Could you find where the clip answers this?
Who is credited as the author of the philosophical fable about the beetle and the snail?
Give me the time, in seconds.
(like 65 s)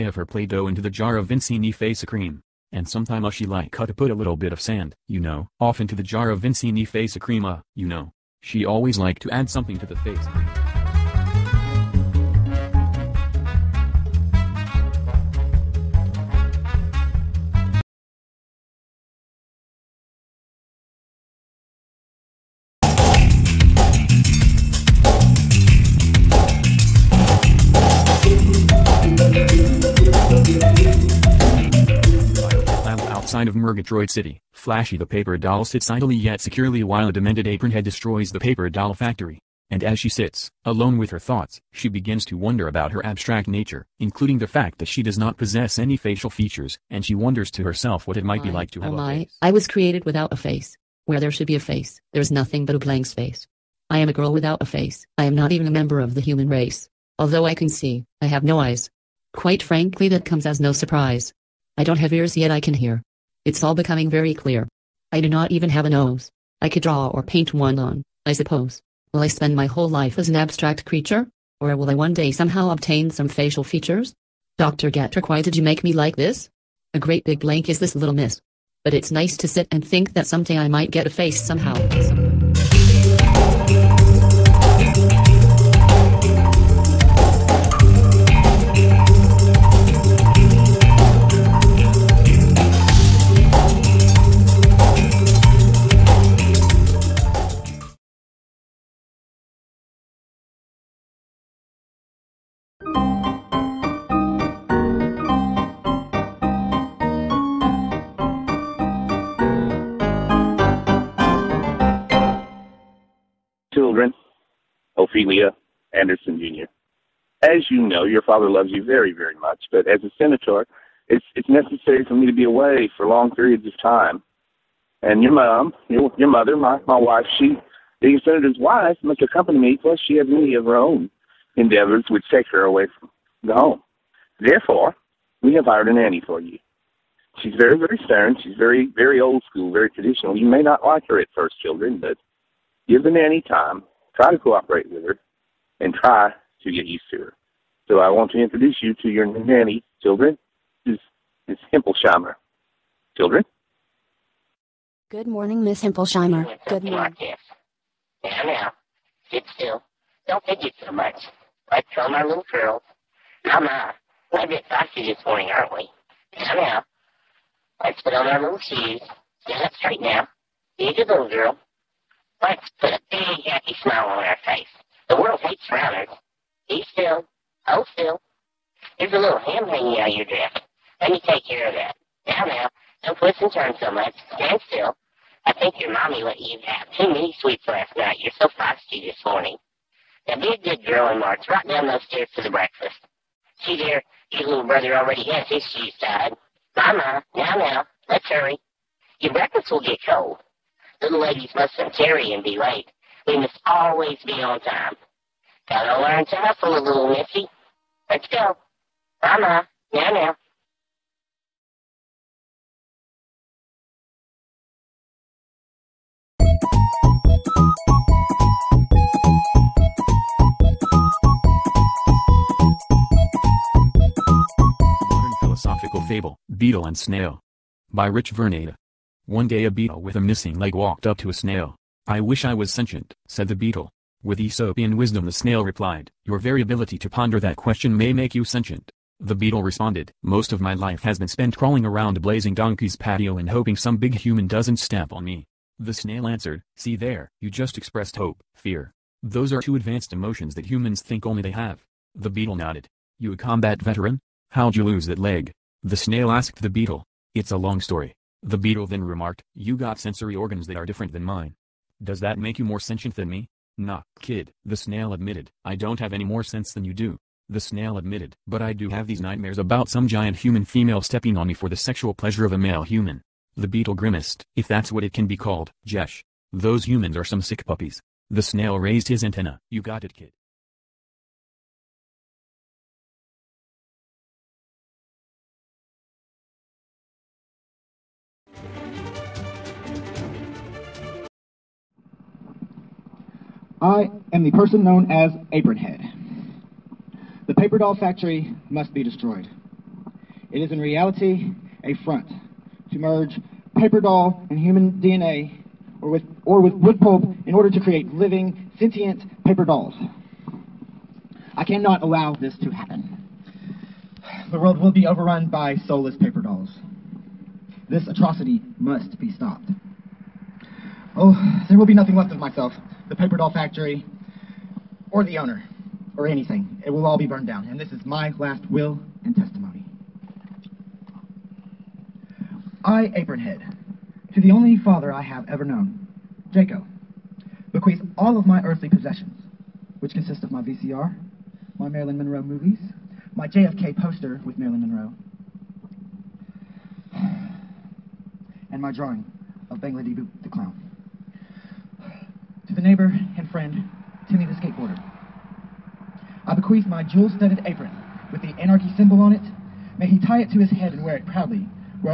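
228 s.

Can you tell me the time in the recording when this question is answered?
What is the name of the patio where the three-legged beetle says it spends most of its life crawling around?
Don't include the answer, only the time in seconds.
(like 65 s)
242 s.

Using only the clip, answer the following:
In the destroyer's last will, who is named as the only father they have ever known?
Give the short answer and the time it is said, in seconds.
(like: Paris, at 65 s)
Jacob, at 336 s.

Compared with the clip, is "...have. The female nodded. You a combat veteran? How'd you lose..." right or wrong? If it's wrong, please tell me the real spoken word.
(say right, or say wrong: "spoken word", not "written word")
wrong: "beetle", not "female".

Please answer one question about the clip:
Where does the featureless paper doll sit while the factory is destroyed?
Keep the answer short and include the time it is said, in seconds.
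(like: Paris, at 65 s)
Mergatroid City, at 33 s.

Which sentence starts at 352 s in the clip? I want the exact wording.
To the neighbor and friend, Timmy the Skateboarder.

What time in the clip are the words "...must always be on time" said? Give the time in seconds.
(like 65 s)
203 s.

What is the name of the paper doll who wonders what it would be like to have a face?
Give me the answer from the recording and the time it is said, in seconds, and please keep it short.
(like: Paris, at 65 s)
Flashy, at 34 s.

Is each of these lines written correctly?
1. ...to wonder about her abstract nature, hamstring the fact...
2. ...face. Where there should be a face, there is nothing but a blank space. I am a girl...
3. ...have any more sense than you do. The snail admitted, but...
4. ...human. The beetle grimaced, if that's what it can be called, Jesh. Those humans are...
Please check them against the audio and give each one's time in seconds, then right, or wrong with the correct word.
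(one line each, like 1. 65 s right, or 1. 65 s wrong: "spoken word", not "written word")
1. 42 s wrong: "including", not "hamstring"
2. 50 s right
3. 265 s right
4. 272 s right.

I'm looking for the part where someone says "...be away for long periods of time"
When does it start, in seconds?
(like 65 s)
122 s.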